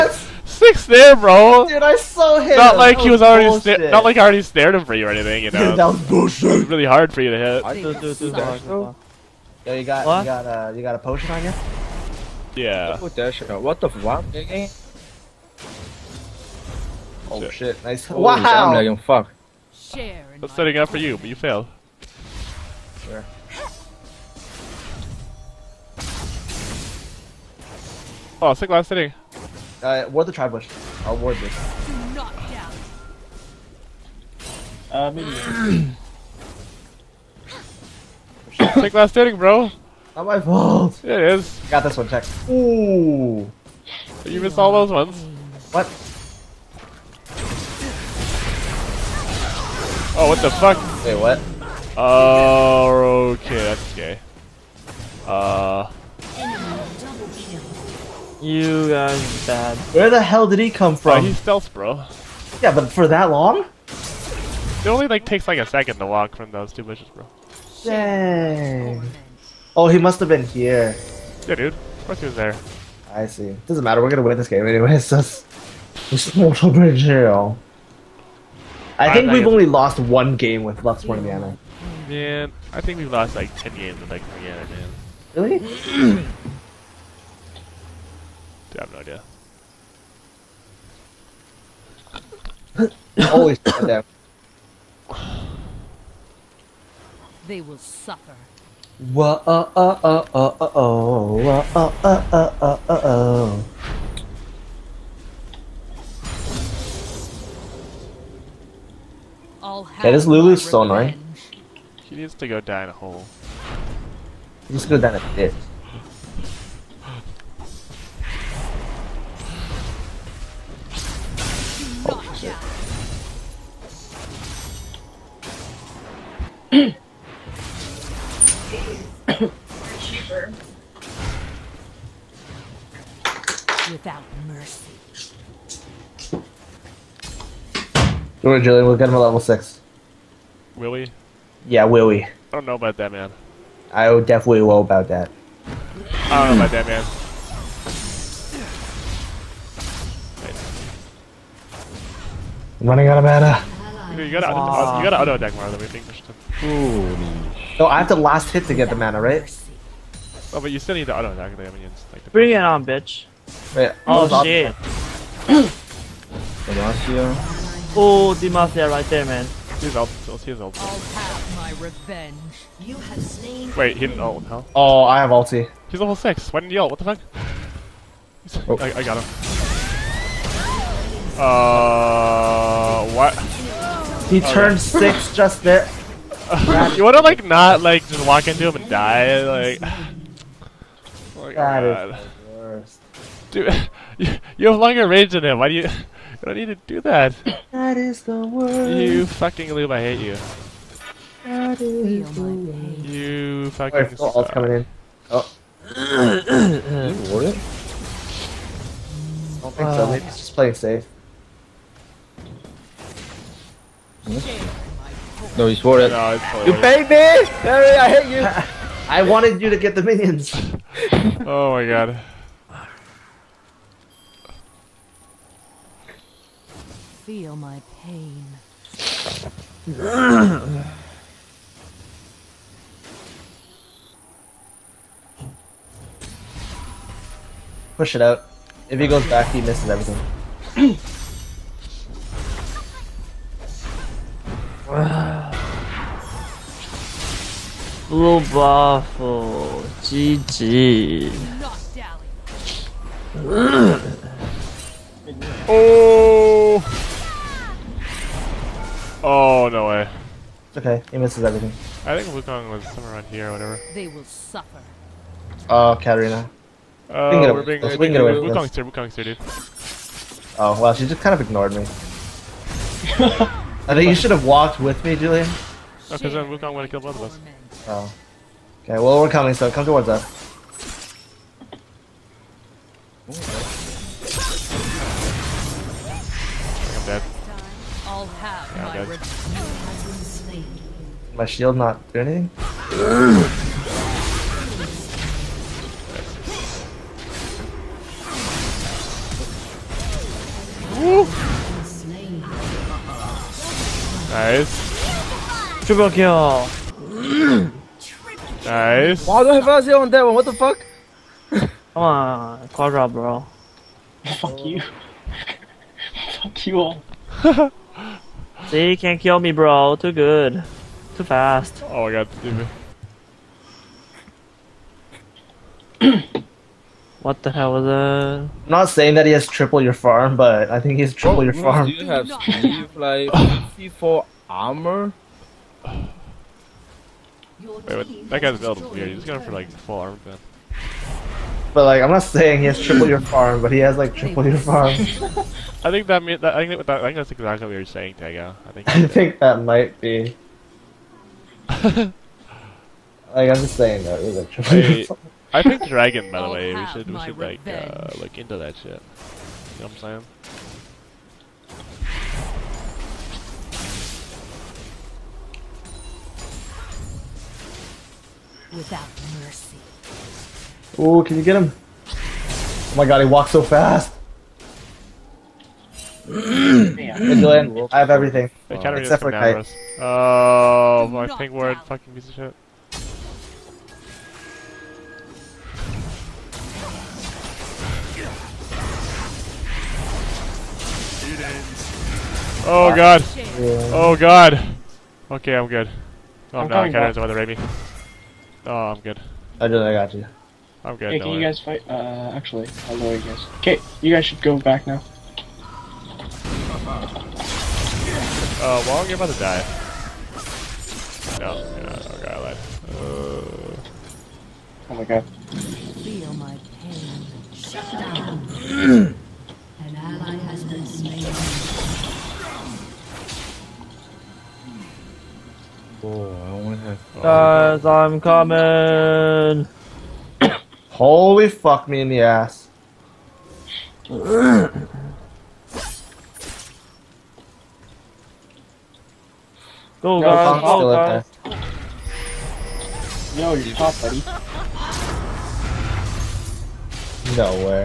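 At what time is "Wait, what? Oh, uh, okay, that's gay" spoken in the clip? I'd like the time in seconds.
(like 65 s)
51 s.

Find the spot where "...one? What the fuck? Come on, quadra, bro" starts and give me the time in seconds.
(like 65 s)
310 s.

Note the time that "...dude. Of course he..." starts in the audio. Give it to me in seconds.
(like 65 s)
71 s.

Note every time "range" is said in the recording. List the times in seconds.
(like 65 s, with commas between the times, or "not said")
195 s.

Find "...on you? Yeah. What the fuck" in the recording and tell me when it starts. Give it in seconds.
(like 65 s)
11 s.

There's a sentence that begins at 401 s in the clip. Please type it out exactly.
Uh, actually, I'll lower you guys.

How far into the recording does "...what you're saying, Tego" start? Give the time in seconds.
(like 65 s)
347 s.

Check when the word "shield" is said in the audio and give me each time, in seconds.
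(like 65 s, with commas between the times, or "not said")
291 s.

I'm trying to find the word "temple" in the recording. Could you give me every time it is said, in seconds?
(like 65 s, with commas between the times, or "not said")
not said.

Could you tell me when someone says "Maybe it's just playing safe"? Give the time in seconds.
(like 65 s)
210 s.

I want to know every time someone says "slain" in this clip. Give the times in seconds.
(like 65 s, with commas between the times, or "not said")
173 s, 420 s.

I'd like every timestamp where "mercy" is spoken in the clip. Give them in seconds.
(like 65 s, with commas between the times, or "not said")
134 s, 369 s.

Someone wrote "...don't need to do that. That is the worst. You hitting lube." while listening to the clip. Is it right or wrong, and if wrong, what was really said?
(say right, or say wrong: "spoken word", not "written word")
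wrong: "fucking", not "hitting".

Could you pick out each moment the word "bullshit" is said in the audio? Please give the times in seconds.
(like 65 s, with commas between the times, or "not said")
6 s.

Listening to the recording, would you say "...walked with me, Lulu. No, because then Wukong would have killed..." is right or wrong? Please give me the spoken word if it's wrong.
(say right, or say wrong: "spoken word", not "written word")
wrong: "Julian", not "Lulu".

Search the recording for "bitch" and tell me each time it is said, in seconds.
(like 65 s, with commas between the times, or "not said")
162 s.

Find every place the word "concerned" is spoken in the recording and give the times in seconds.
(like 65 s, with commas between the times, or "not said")
not said.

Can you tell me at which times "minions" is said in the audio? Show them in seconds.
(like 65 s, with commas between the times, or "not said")
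161 s, 220 s.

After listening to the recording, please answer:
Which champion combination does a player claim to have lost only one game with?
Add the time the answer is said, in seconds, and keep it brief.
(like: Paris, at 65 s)
Lux Mordiana, at 80 s.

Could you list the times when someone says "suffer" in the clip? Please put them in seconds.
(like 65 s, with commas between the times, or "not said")
97 s, 264 s.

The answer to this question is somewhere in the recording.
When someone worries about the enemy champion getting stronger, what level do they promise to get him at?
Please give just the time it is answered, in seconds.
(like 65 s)
139 s.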